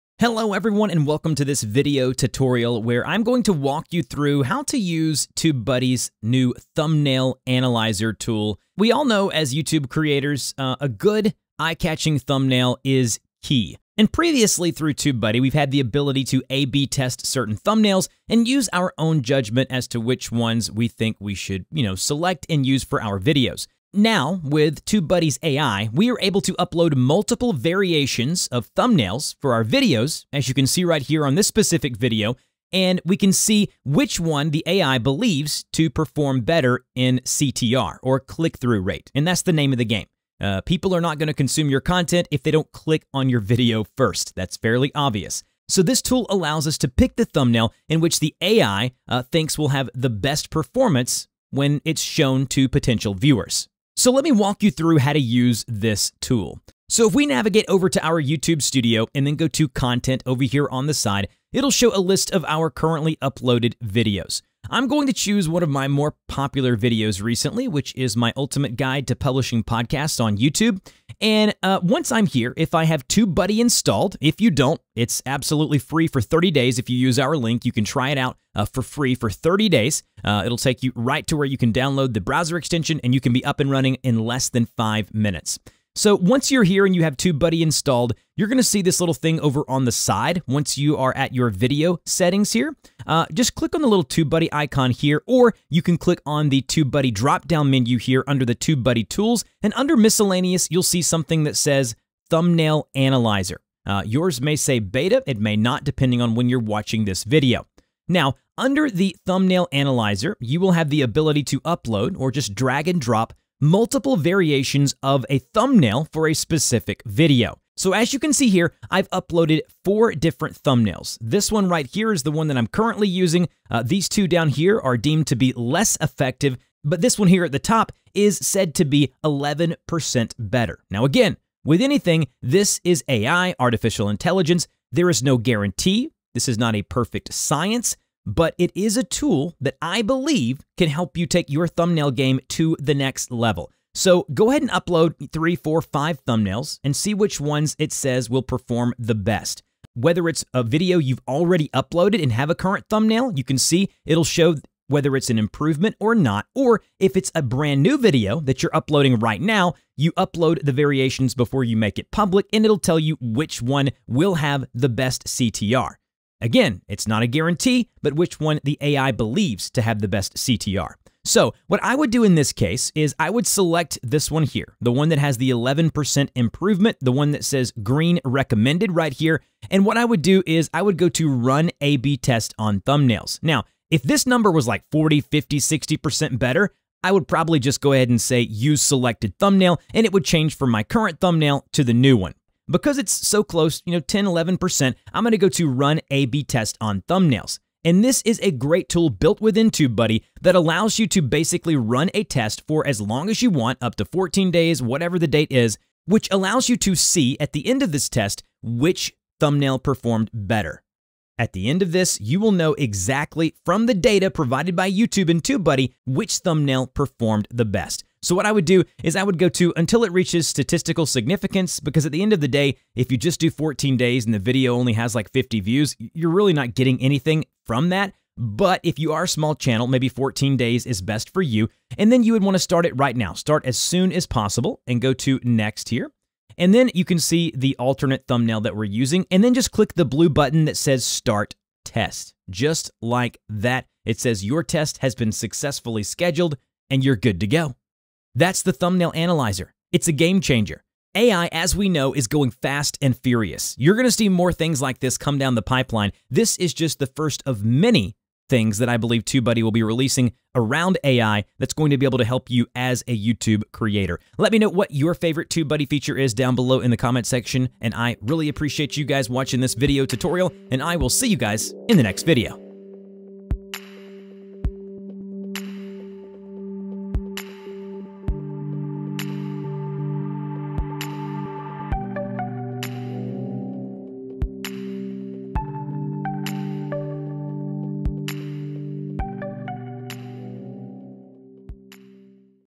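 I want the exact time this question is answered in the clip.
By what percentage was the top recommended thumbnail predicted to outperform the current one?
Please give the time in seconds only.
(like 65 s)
129 s.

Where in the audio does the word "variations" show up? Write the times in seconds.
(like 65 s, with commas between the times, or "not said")
27 s, 114 s, 160 s.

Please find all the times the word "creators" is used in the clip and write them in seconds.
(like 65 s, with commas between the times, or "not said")
9 s, 263 s.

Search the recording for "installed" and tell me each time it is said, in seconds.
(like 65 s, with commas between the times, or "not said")
73 s, 87 s.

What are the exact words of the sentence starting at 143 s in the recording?
So go ahead and upload three, four, five thumbnails and see which ones it says will perform the best.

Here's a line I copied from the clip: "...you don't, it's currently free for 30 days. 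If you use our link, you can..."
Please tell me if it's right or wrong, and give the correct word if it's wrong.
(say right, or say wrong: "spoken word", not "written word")
wrong: "absolutely", not "currently".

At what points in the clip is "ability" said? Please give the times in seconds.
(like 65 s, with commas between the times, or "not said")
15 s, 111 s.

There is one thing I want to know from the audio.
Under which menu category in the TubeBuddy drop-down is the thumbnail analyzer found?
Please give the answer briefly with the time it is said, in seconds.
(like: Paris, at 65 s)
Miscellaneous, at 99 s.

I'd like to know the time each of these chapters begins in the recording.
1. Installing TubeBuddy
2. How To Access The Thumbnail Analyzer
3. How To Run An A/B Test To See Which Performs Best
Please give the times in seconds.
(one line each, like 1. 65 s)
1. 74 s
2. 91 s
3. 196 s.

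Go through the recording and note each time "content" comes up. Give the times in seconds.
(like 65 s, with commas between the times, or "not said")
41 s, 59 s.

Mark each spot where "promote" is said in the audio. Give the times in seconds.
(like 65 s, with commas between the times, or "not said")
not said.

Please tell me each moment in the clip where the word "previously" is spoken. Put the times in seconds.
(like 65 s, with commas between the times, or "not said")
14 s.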